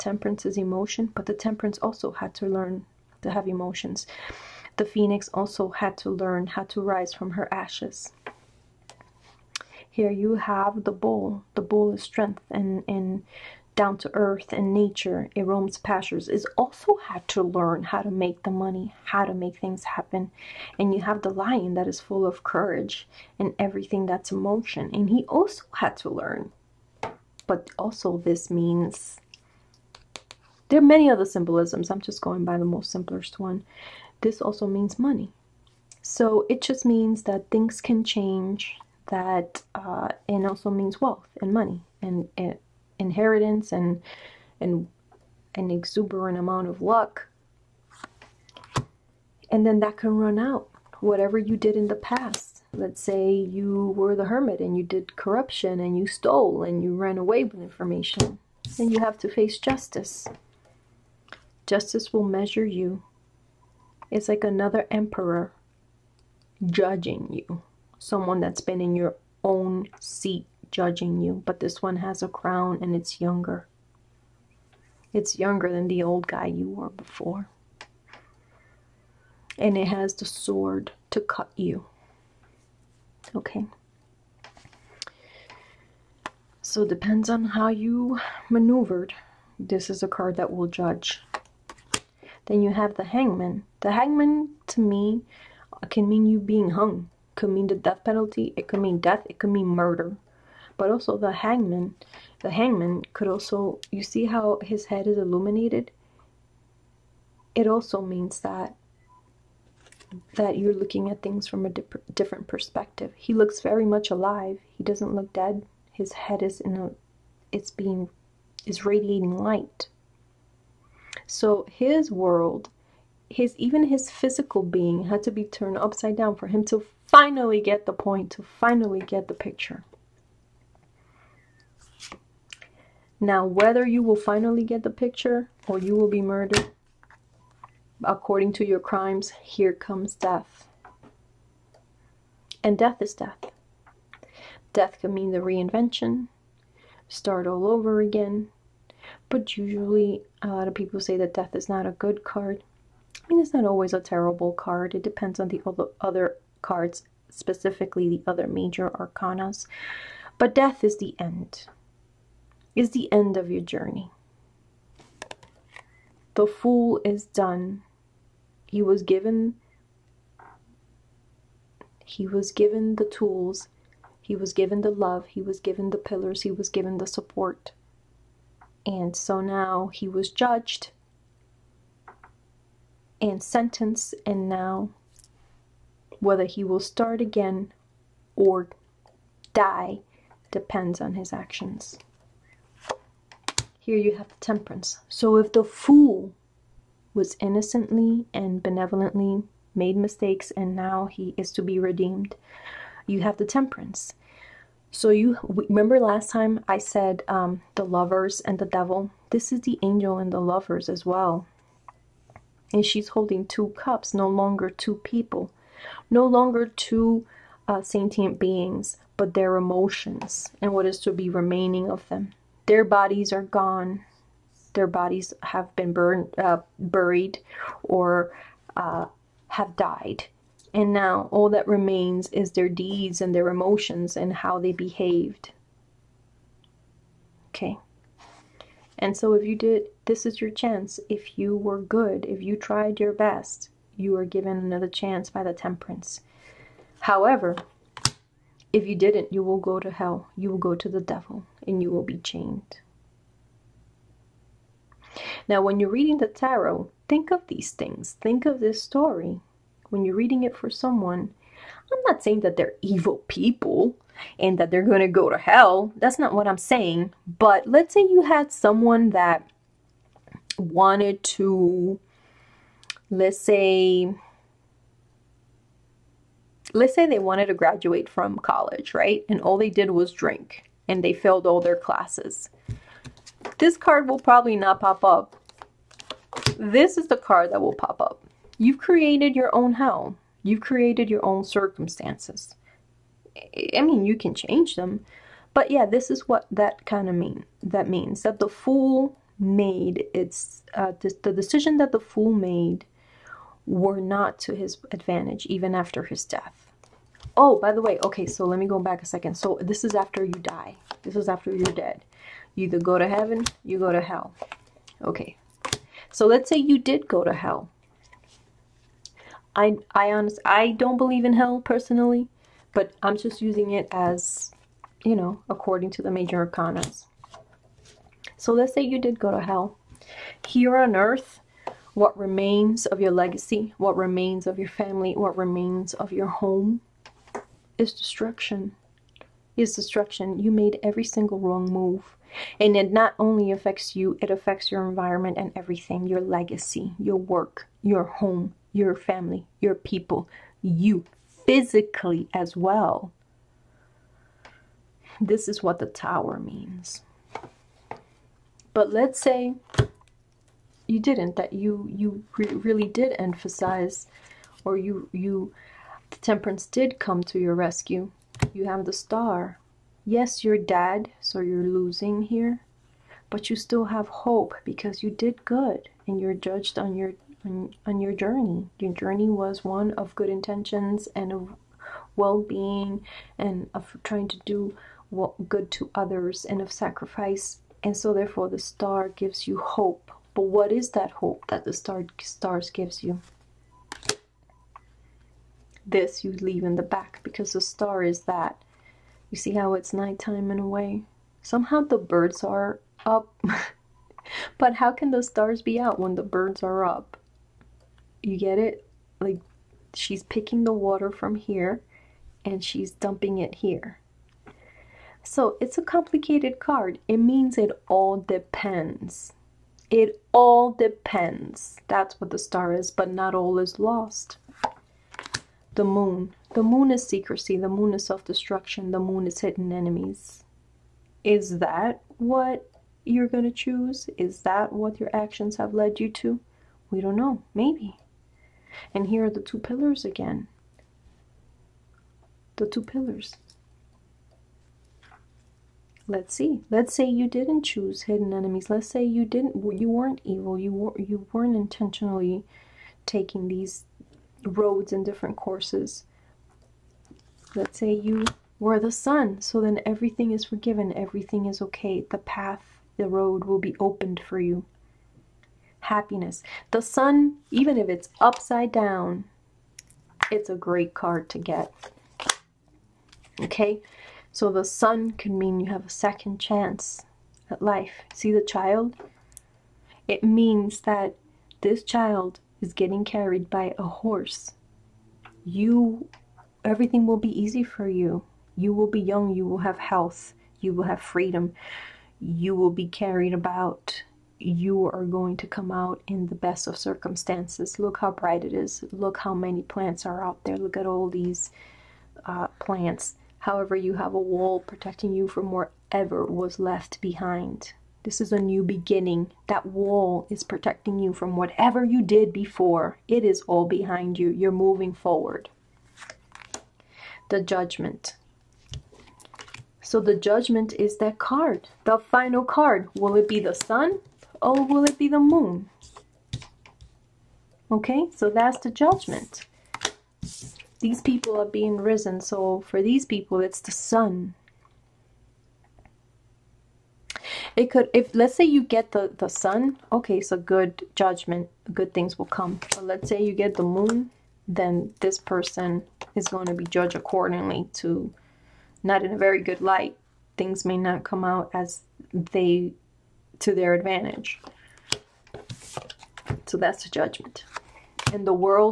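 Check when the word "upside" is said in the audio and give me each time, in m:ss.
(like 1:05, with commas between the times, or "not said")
2:05, 7:48.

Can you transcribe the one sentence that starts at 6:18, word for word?
Your journey was one of good intentions and of well-being and of trying to do what good to others and of sacrifice.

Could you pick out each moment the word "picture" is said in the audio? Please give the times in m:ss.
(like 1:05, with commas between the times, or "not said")
2:09, 2:14.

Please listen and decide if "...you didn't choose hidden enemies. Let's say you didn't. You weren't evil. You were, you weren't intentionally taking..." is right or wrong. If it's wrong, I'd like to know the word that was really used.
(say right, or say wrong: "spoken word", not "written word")
right.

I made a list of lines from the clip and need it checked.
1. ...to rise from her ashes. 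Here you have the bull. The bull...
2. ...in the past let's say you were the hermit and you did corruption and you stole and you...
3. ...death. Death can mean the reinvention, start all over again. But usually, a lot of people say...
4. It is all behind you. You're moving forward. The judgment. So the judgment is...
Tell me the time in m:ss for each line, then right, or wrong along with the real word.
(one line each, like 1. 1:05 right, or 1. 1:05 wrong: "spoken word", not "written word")
1. 0:06 right
2. 0:51 right
3. 2:23 right
4. 8:33 right.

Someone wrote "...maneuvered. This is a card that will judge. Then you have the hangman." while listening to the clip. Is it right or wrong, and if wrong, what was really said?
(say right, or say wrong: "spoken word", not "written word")
right.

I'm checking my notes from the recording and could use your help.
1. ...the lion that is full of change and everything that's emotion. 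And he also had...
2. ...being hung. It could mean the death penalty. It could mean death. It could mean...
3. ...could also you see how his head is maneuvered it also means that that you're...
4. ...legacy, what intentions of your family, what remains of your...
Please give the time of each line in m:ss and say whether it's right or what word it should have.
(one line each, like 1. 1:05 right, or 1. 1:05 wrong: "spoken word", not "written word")
1. 0:21 wrong: "courage", not "change"
2. 1:36 right
3. 1:43 wrong: "illuminated", not "maneuvered"
4. 5:33 wrong: "remains", not "intentions".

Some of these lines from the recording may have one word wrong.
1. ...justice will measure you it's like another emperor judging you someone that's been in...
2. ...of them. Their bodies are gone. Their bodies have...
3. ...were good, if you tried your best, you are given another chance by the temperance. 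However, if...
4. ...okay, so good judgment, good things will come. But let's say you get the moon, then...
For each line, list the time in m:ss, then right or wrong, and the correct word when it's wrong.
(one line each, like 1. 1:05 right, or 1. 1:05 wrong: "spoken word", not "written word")
1. 1:01 right
2. 3:41 right
3. 4:01 right
4. 8:59 right.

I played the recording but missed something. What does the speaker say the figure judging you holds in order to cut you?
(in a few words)
The sword.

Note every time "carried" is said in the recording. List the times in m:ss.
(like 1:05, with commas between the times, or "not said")
8:03, 8:12.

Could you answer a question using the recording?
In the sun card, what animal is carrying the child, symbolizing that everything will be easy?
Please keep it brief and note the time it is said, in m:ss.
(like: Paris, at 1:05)
A horse, at 8:03.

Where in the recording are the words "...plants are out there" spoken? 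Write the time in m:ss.
8:19.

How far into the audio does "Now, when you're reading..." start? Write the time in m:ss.
4:15.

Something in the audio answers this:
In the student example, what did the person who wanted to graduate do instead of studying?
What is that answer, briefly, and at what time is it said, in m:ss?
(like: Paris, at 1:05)
Drink, at 4:40.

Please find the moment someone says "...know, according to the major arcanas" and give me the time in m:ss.
5:25.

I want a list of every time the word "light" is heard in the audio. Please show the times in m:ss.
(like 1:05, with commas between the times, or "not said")
1:59, 9:09.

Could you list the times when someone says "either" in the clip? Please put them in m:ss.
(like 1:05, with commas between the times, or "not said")
5:12.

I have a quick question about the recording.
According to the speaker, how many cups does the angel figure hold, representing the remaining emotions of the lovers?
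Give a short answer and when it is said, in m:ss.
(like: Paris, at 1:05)
2, at 3:33.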